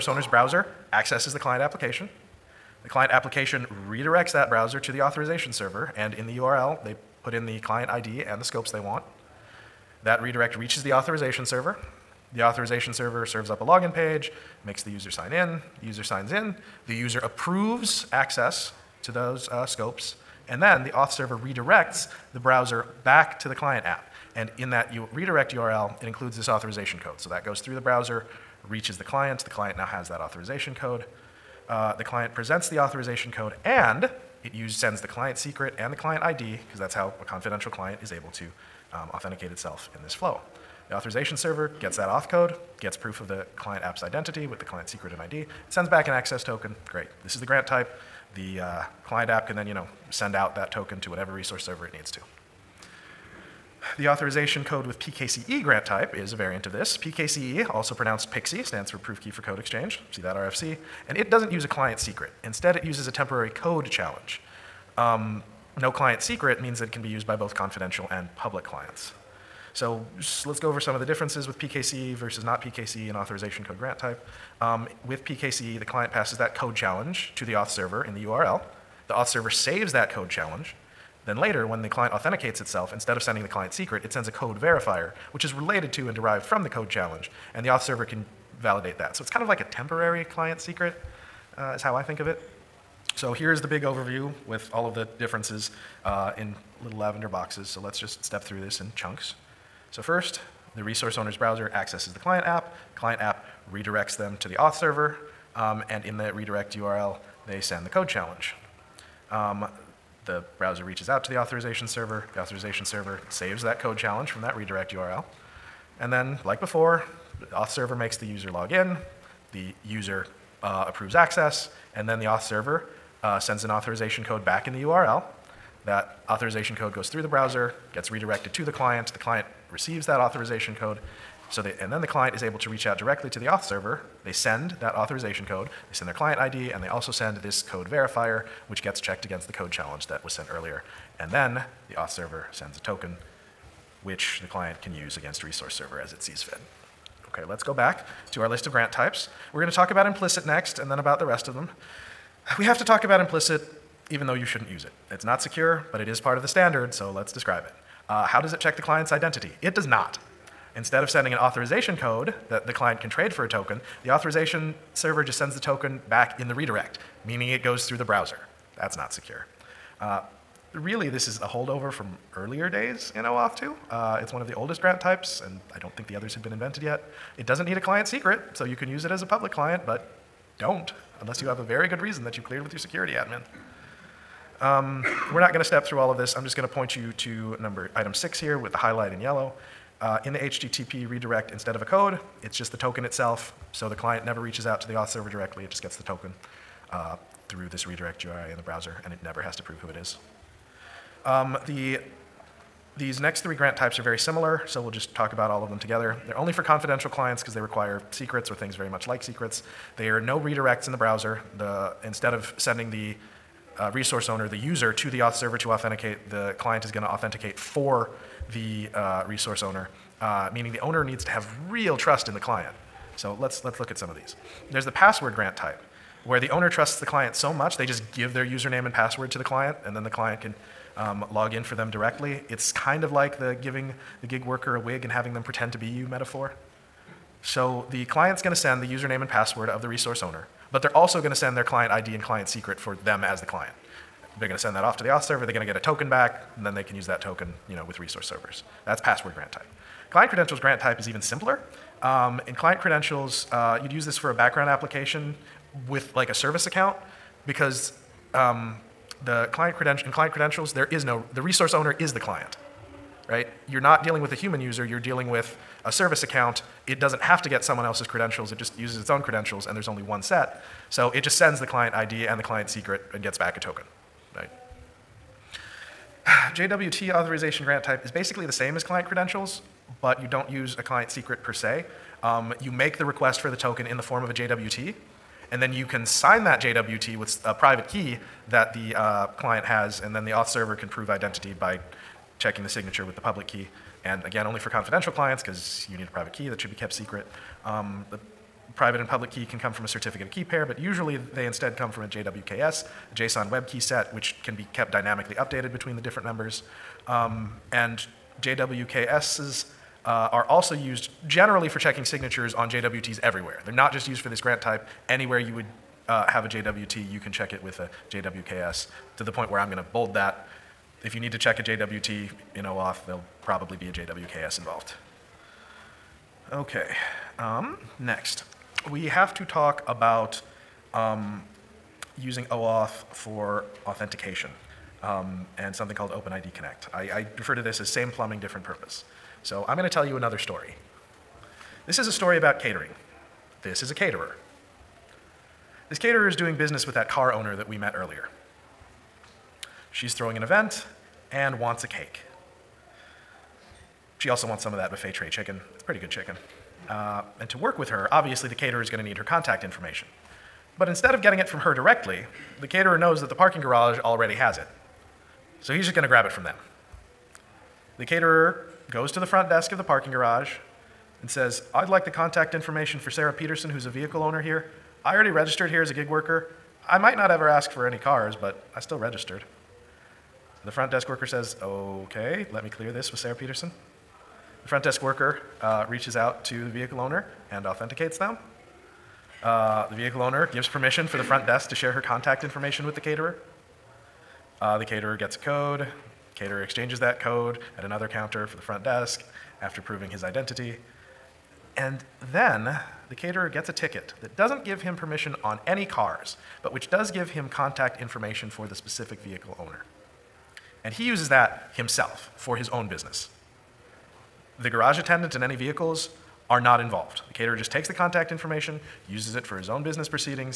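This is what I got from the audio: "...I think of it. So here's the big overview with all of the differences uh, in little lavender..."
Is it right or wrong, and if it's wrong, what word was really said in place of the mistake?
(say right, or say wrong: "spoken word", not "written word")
right.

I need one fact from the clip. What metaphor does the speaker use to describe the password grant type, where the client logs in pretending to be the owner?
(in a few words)
A wig.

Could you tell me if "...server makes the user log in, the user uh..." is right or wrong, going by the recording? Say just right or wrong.
right.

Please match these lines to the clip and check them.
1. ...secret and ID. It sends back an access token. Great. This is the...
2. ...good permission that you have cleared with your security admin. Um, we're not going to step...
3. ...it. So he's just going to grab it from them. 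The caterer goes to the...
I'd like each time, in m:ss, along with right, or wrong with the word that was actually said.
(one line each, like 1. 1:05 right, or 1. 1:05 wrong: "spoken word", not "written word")
1. 0:44 right
2. 3:01 wrong: "reason", not "permission"
3. 6:04 right.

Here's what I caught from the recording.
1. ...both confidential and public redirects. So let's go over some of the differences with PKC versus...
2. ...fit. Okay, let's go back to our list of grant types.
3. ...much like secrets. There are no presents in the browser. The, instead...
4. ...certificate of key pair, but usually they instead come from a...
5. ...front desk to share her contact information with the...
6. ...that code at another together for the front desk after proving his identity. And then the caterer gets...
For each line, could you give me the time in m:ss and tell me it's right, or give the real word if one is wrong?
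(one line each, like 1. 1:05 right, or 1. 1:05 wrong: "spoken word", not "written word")
1. 1:07 wrong: "clients", not "redirects"
2. 2:26 right
3. 3:28 wrong: "redirects", not "presents"
4. 4:59 right
5. 6:31 right
6. 6:36 wrong: "counter", not "together".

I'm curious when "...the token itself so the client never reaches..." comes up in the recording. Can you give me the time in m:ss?
3:12.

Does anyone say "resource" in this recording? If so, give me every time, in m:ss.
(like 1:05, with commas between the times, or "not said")
0:51, 1:40, 2:25, 3:33, 3:39, 3:59, 4:07, 4:21.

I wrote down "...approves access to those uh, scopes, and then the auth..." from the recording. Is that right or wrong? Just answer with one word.
right.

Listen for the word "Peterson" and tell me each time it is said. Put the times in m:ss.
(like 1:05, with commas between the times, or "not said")
6:13, 6:23.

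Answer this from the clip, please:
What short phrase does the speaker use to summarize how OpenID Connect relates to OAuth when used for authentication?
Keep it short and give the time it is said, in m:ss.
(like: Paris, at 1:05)
Same plumbing, different purpose, at 5:37.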